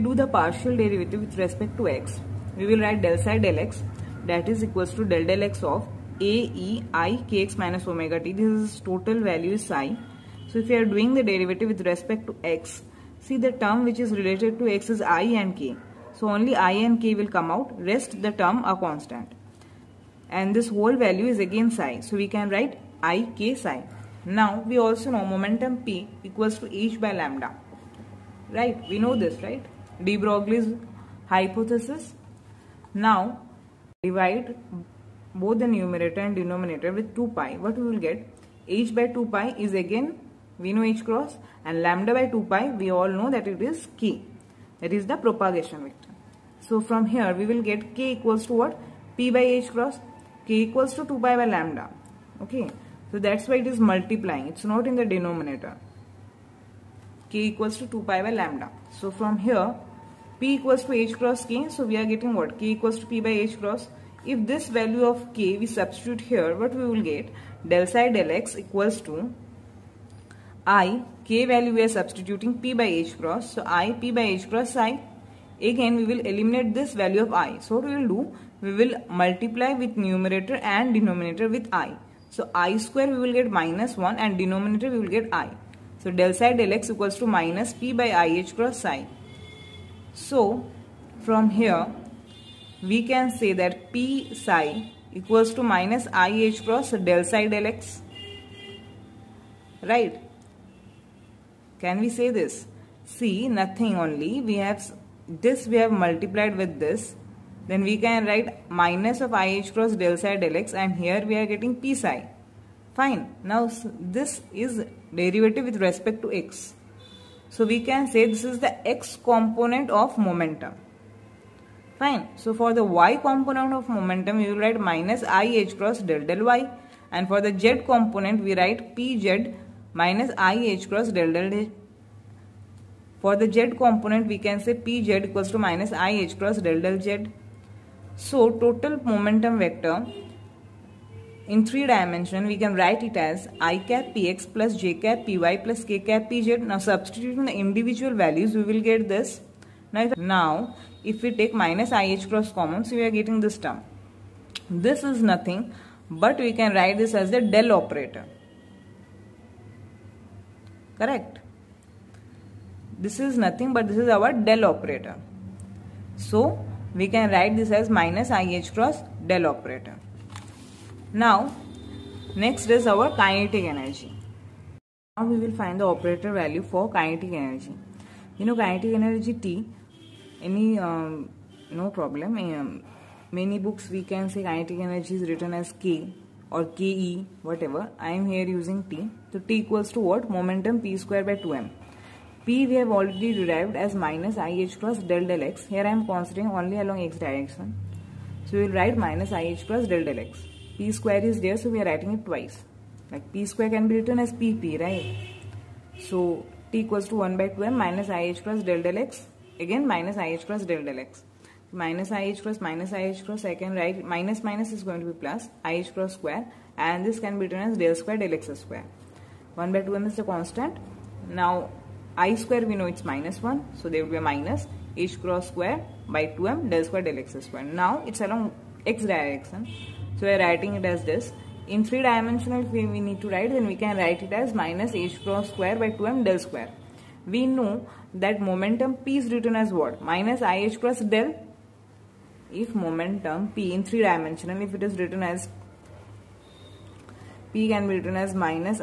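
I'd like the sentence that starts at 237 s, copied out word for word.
We know that momentum p is written as what?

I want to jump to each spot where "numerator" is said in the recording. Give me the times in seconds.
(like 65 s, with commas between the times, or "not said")
35 s, 79 s.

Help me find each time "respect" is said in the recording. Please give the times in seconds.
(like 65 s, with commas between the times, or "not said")
1 s, 11 s, 115 s.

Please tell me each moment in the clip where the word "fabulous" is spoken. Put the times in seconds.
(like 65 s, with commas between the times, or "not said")
not said.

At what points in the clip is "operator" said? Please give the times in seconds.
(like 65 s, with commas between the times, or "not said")
157 s, 164 s, 169 s, 175 s.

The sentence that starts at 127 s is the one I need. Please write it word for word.
And for the z component, we write p z minus i h cross del del h.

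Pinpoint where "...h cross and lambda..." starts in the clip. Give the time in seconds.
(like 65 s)
40 s.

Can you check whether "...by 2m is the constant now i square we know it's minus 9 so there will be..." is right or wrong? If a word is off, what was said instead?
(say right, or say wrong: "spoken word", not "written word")
wrong: "1", not "9".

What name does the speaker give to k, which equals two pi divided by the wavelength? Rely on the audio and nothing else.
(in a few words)
propagation vector.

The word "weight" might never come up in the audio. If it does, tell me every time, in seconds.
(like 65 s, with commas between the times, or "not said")
not said.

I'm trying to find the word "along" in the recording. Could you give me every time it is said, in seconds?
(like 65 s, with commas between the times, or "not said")
196 s, 228 s.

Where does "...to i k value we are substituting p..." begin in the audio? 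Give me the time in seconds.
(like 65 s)
69 s.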